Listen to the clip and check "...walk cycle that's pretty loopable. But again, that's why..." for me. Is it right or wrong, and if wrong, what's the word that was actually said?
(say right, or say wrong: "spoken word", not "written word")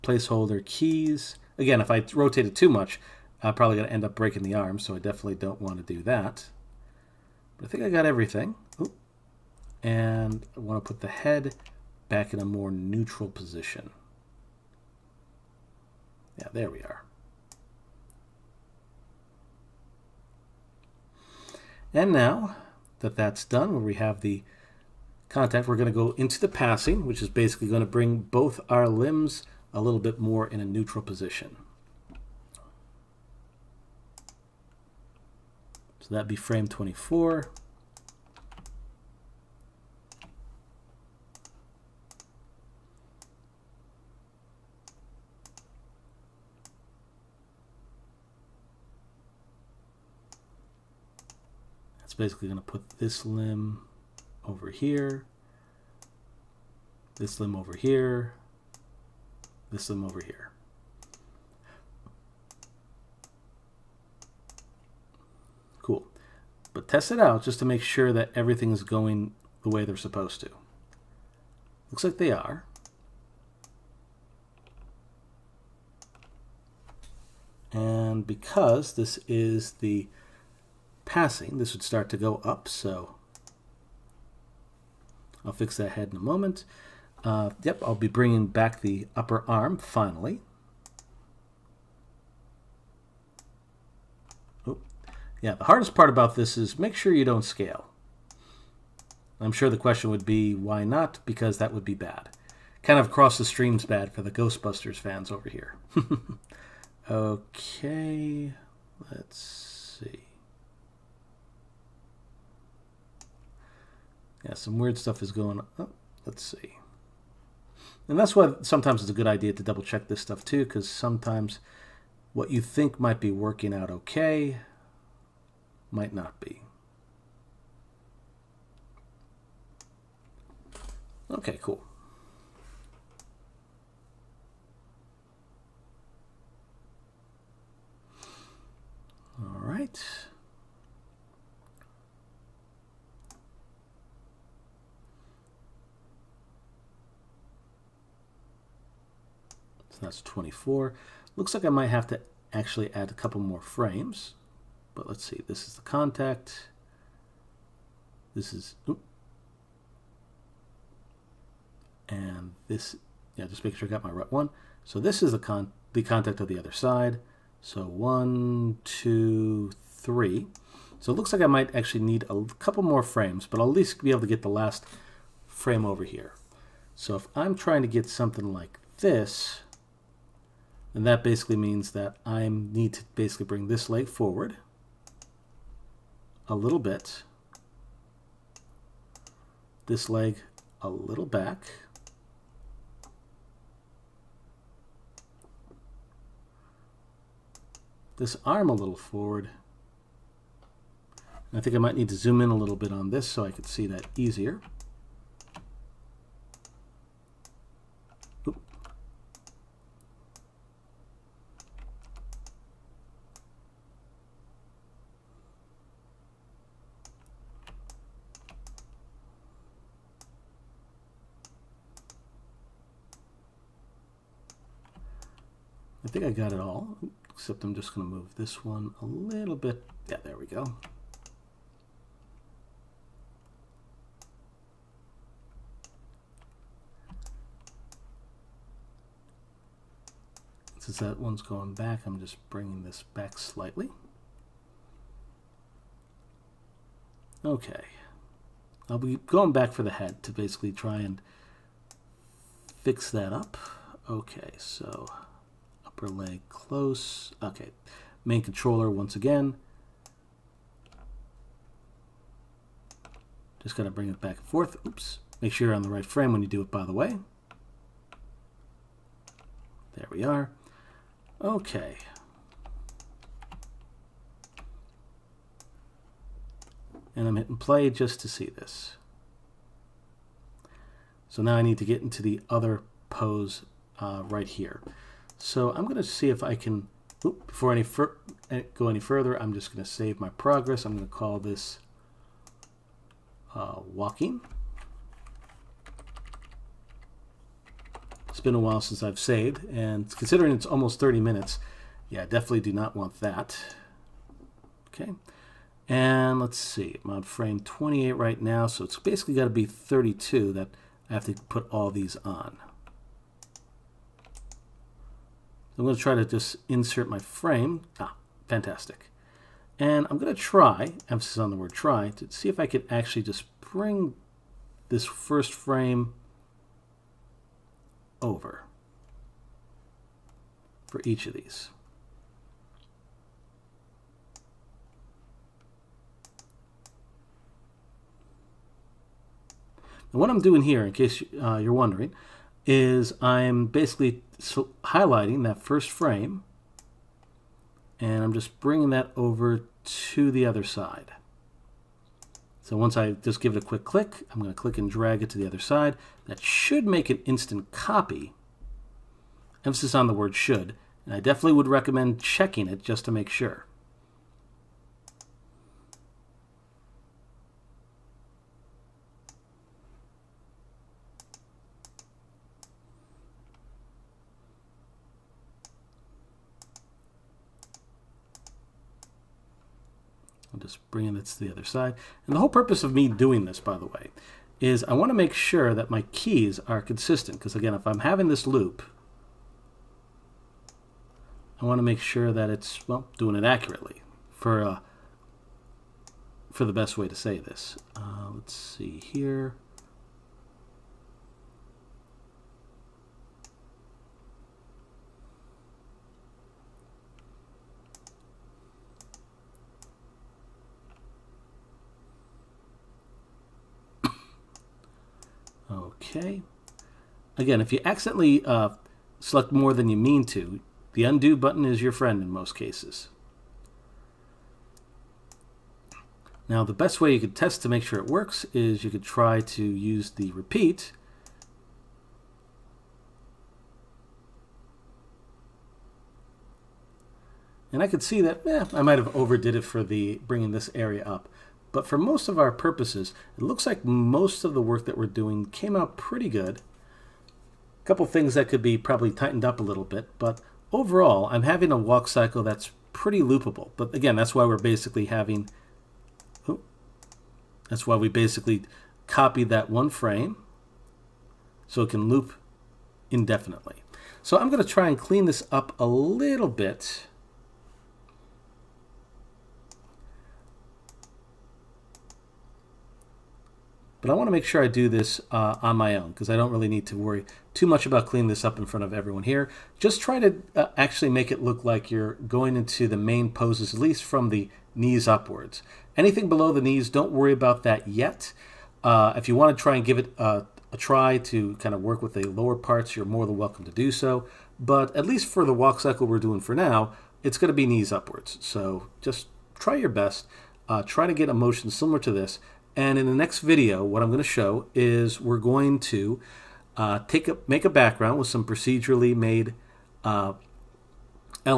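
right.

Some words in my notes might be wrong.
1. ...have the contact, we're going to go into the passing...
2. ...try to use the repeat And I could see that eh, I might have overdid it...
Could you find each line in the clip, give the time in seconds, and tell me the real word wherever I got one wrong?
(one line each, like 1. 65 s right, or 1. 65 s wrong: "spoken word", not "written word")
1. 23 s right
2. 429 s right.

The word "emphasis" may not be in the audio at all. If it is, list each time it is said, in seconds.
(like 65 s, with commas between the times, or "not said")
321 s, 359 s.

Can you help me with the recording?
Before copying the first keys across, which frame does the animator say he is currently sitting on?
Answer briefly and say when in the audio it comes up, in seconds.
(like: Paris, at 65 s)
28, at 307 s.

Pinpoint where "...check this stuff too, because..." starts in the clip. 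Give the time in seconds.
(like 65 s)
119 s.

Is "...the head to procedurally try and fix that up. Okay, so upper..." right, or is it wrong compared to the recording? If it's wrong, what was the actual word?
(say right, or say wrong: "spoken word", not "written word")
wrong: "basically", not "procedurally".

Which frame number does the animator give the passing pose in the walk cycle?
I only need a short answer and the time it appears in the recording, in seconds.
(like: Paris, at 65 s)
24, at 36 s.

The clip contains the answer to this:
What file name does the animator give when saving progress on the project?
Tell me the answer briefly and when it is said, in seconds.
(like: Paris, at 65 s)
walking, at 293 s.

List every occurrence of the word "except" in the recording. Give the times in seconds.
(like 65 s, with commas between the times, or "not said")
227 s.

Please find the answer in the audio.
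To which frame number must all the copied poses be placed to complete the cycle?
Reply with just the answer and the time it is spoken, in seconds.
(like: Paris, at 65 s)
32, at 309 s.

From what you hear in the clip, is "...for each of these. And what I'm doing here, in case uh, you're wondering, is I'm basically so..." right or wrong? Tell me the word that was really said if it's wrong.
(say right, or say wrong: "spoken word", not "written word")
right.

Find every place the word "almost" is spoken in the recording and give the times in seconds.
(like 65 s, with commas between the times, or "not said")
300 s.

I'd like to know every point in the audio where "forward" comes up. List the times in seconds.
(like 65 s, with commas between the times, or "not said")
184 s, 198 s.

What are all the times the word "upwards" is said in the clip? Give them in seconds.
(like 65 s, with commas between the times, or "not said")
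485 s, 497 s.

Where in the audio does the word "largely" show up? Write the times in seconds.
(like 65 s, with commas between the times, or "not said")
not said.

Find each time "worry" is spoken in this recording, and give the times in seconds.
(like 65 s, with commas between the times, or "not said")
476 s, 487 s.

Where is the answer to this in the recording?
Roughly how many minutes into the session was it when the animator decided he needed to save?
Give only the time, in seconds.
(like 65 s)
300 s.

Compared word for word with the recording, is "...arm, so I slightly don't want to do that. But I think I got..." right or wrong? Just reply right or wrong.
wrong.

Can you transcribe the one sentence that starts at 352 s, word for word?
So once I just give it a quick click, I'm going to click and drag it to the other side.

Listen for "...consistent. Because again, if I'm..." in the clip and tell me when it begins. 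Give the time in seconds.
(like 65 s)
386 s.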